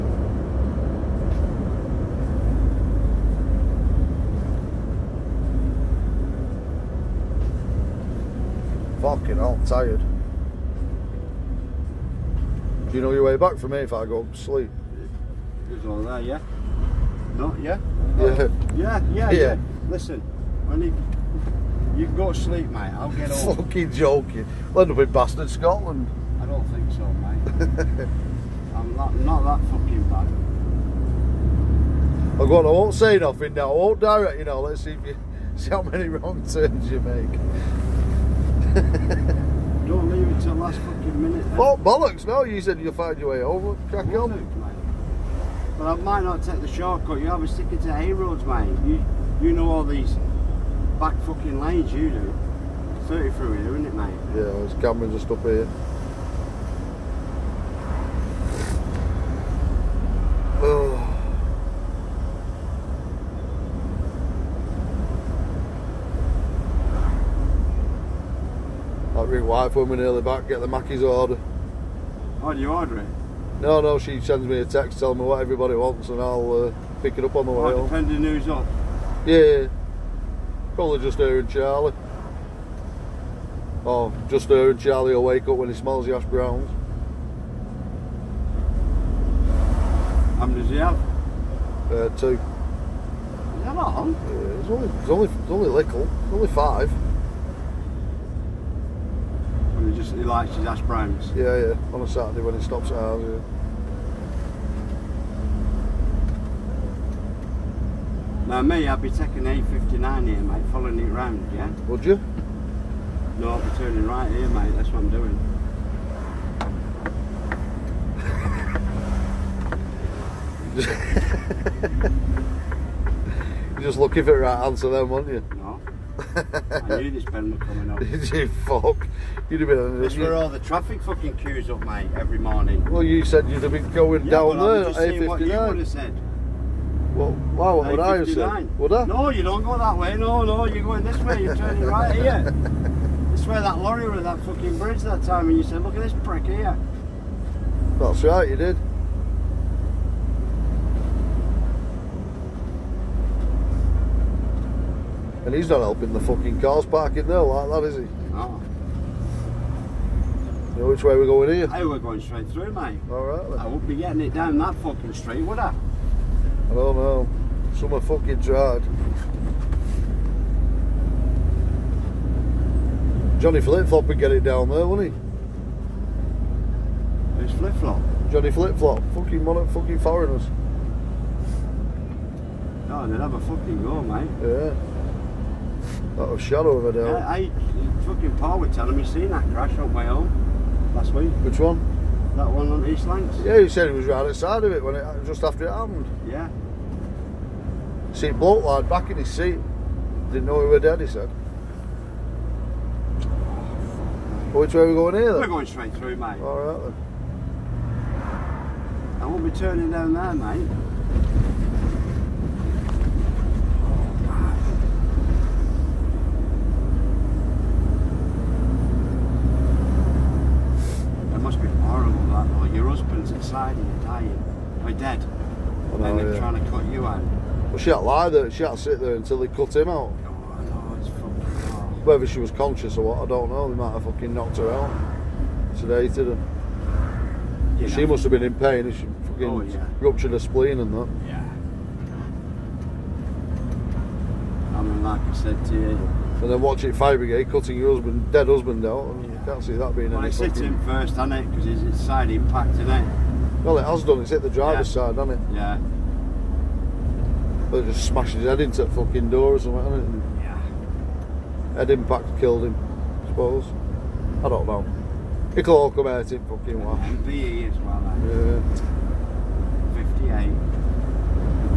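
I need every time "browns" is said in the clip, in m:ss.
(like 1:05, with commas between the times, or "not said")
1:26, 1:40.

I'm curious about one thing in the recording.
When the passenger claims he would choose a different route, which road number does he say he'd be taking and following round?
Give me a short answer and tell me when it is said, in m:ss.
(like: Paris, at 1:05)
A59, at 1:49.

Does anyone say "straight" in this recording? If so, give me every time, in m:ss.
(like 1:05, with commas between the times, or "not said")
2:42, 3:25.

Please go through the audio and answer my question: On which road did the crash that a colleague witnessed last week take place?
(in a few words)
East Lancs.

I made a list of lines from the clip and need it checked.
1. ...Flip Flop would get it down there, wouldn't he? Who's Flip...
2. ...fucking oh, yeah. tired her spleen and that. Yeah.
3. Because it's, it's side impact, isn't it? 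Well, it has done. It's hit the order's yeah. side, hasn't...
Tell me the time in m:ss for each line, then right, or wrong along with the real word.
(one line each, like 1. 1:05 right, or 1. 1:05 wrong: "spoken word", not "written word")
1. 2:53 right
2. 3:59 wrong: "ruptured", not "tired"
3. 4:11 wrong: "driver", not "order".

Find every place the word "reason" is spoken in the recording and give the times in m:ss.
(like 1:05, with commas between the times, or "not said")
not said.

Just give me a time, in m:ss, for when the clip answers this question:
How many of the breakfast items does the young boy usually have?
1:32.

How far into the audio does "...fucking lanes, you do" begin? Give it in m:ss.
0:51.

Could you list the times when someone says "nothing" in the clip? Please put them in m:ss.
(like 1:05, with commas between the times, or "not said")
0:33.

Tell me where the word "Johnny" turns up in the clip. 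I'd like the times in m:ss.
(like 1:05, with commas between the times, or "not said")
2:53, 2:58.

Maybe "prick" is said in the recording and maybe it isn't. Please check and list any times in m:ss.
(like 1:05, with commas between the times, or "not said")
2:26.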